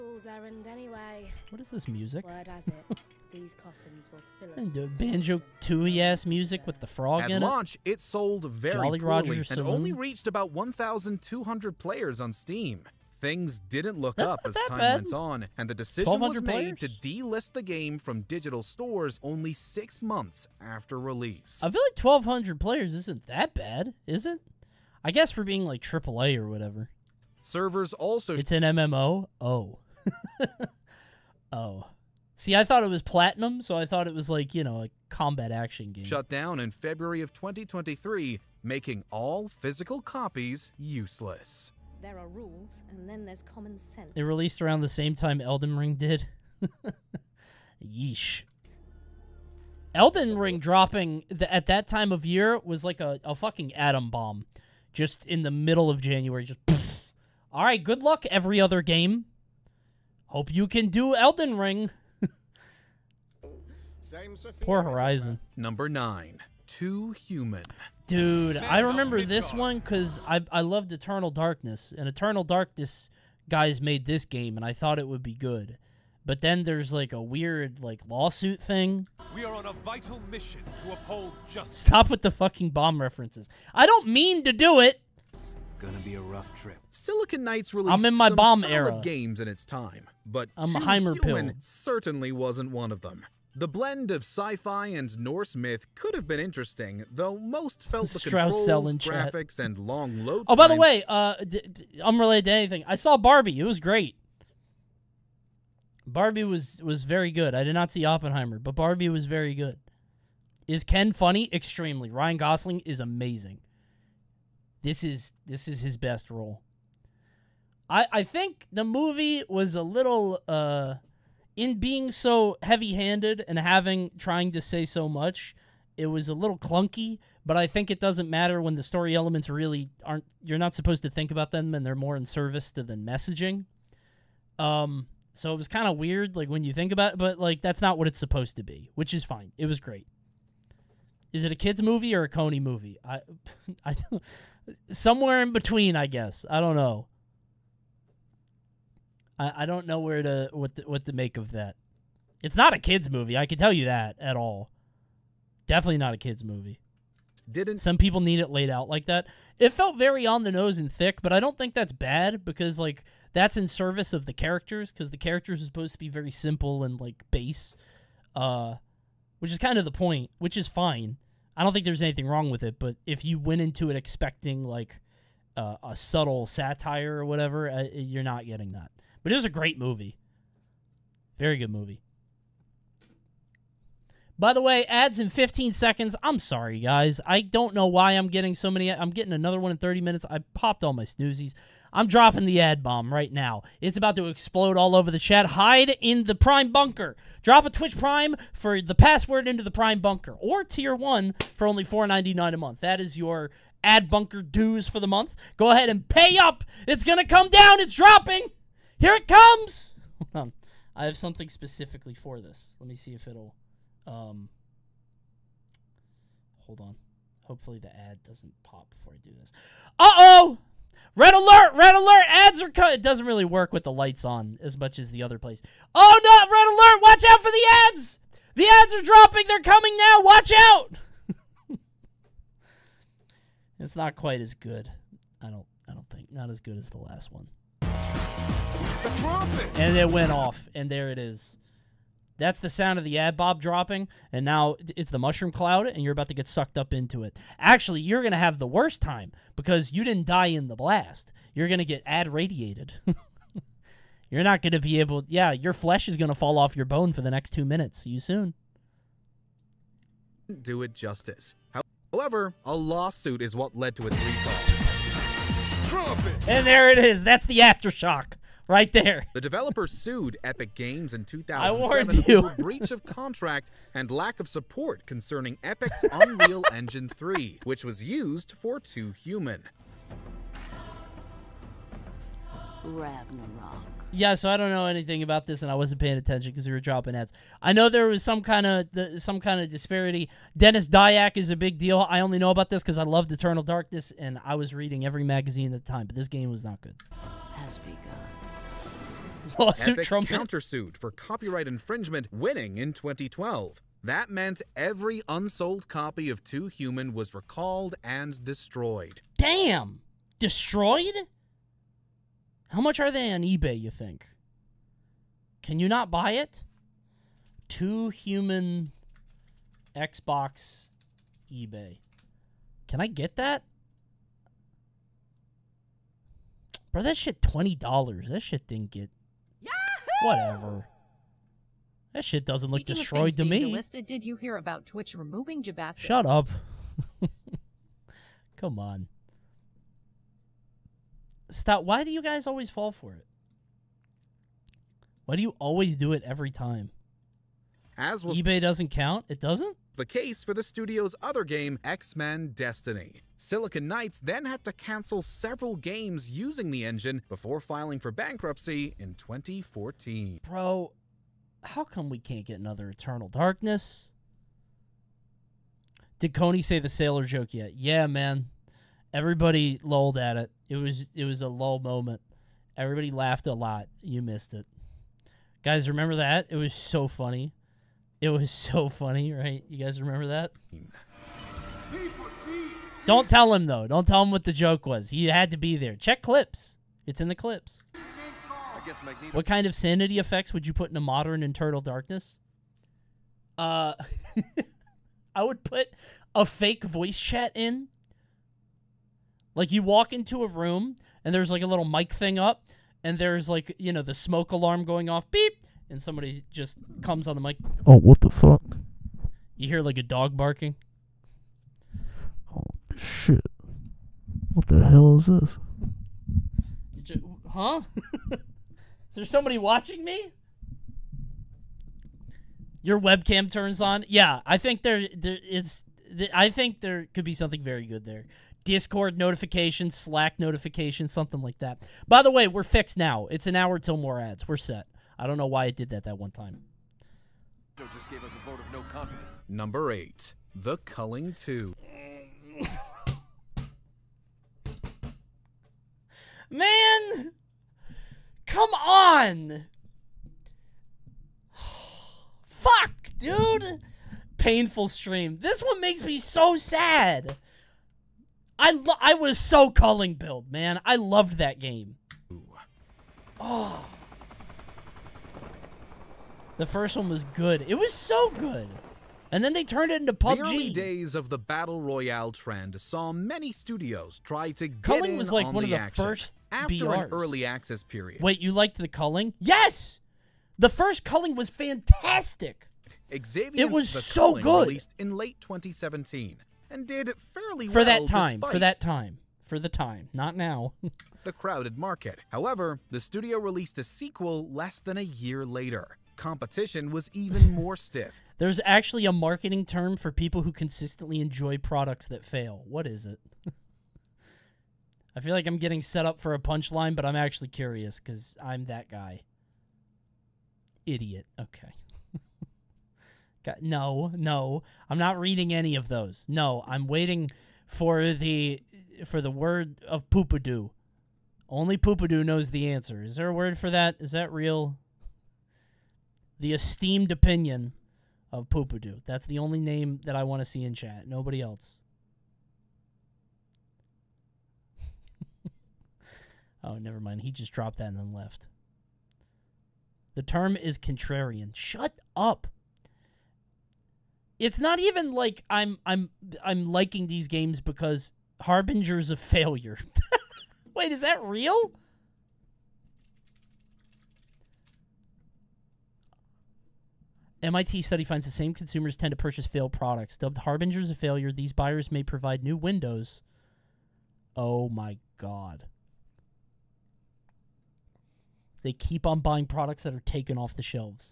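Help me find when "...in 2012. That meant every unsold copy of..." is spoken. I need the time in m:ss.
5:02.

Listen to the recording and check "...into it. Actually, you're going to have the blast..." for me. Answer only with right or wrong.
wrong.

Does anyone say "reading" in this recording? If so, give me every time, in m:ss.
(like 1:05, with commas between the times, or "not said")
4:54, 8:35.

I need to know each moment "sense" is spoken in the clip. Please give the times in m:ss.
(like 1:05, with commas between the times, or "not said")
0:43.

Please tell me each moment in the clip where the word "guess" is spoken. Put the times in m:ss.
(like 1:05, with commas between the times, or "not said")
0:25, 2:26.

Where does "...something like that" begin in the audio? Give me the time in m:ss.
7:11.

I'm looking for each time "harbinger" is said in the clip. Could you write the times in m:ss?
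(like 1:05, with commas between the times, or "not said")
9:08, 9:20.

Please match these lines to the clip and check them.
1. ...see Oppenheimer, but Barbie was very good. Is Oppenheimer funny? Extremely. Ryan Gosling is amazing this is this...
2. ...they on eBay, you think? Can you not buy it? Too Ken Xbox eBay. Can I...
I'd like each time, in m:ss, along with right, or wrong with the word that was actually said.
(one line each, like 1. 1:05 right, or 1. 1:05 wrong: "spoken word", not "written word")
1. 1:47 wrong: "Ken", not "Oppenheimer"
2. 5:13 wrong: "Human", not "Ken".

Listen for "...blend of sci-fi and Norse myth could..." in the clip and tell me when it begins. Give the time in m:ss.
1:33.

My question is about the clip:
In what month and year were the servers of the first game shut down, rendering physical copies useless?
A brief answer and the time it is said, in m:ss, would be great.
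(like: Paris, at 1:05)
February 2023, at 0:36.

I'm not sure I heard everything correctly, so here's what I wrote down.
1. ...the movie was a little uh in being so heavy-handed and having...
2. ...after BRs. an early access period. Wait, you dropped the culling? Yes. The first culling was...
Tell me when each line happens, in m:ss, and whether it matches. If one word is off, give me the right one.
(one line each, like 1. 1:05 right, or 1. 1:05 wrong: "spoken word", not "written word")
1. 1:58 right
2. 7:56 wrong: "liked", not "dropped".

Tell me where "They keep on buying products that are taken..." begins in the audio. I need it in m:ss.
9:28.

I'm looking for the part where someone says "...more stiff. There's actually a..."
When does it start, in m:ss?
8:17.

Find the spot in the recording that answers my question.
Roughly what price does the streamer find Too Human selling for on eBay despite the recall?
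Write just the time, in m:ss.
5:27.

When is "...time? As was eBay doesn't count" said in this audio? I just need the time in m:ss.
5:46.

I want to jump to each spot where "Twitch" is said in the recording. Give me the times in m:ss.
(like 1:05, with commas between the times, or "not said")
3:17, 5:34.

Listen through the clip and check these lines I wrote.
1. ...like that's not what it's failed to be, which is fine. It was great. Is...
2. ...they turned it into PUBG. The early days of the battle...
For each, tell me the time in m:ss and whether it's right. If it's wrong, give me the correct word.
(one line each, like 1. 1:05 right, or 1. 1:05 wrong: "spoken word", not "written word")
1. 2:17 wrong: "supposed", not "failed"
2. 7:49 right.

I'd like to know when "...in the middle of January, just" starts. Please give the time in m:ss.
0:55.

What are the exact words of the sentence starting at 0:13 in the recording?
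Things didn't look That's up as time bad.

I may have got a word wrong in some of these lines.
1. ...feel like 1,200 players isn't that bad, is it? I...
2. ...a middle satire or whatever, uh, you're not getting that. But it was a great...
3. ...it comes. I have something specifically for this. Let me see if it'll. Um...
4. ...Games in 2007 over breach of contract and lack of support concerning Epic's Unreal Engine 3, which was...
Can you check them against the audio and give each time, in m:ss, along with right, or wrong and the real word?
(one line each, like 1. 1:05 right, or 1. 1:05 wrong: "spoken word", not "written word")
1. 0:21 right
2. 2:55 wrong: "subtle", not "middle"
3. 3:29 right
4. 4:30 right.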